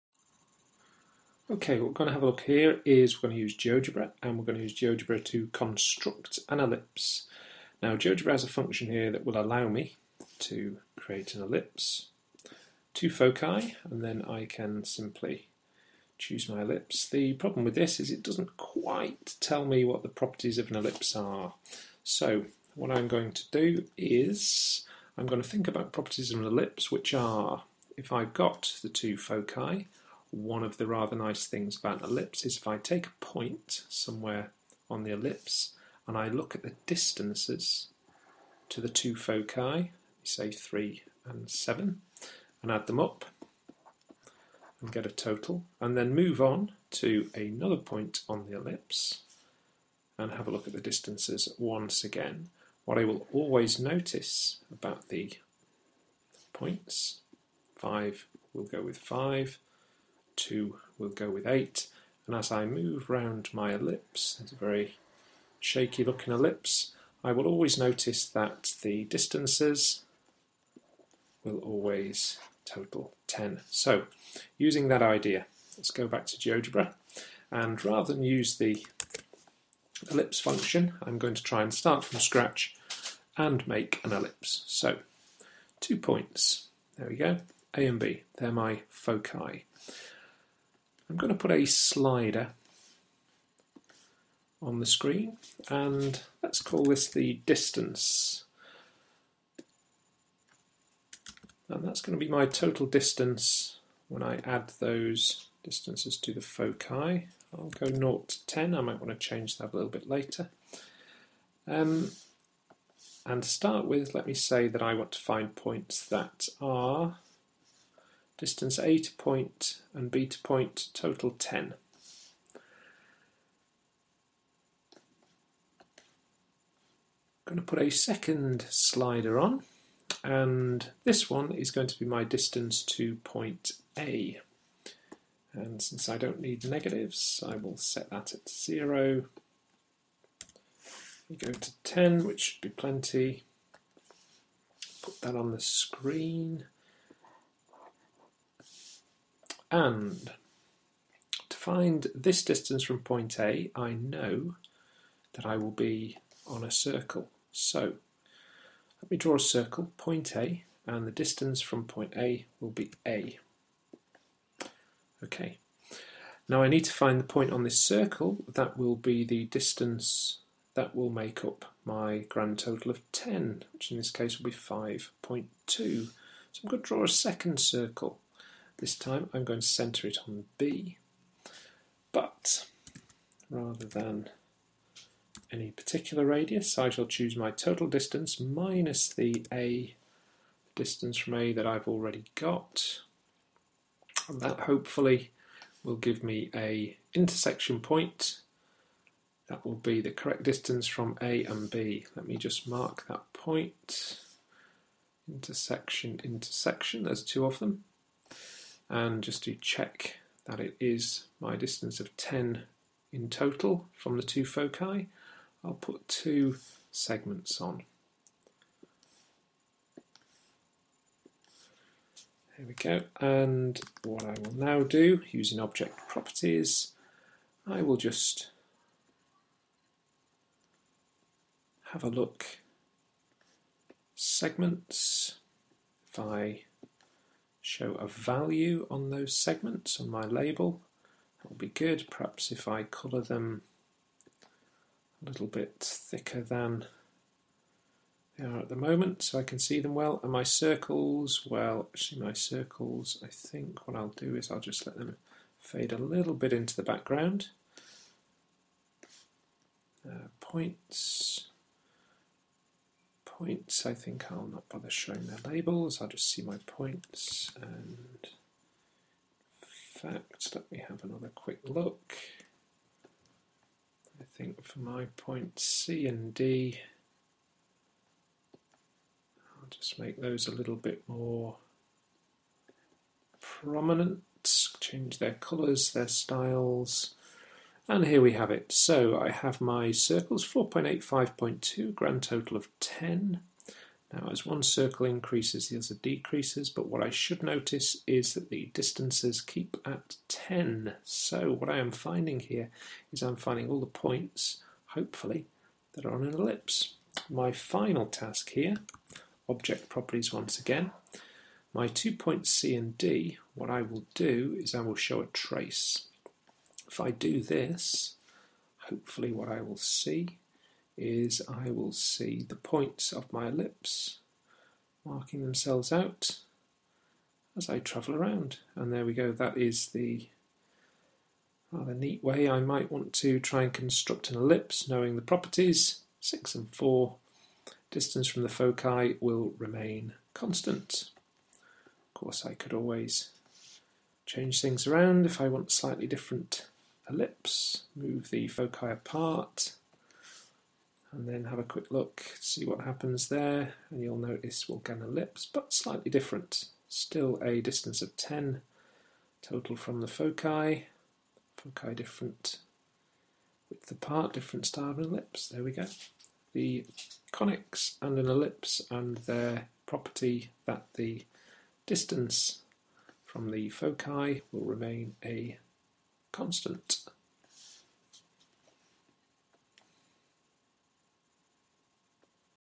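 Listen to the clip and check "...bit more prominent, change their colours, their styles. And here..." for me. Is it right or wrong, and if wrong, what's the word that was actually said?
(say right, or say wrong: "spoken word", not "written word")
right.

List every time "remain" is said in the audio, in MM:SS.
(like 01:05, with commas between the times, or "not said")
05:39, 06:14.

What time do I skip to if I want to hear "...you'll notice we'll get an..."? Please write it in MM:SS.
05:54.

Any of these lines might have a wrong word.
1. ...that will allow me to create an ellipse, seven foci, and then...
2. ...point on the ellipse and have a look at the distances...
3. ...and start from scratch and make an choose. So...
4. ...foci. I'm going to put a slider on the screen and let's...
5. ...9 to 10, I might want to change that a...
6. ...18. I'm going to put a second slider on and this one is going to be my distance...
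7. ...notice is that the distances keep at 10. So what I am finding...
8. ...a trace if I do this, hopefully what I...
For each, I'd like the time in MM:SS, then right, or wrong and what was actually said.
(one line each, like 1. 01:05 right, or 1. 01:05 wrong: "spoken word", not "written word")
1. 00:09 wrong: "two", not "seven"
2. 00:47 right
3. 01:21 wrong: "ellipse", not "choose"
4. 01:28 right
5. 01:47 wrong: "0", not "9"
6. 02:01 wrong: "10", not "18"
7. 04:57 right
8. 05:15 right.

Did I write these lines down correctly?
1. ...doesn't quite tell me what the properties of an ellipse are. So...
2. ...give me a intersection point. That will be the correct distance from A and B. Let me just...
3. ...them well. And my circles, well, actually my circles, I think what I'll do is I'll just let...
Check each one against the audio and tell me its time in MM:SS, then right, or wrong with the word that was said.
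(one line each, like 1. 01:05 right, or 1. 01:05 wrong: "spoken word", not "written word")
1. 00:18 right
2. 03:15 right
3. 04:09 right.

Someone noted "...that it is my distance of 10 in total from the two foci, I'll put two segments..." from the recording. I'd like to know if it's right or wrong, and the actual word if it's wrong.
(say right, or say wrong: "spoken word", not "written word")
right.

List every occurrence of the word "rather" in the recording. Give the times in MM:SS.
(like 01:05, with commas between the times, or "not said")
00:30, 01:17, 03:03, 05:31.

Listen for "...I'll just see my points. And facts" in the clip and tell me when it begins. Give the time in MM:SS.
04:26.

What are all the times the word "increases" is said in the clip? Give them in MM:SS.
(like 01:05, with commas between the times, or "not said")
04:55.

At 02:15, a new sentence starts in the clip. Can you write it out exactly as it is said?
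And since I don't need negatives, I will set that at 0.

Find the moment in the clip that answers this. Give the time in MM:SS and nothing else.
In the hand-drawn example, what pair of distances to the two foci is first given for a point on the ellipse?
00:40.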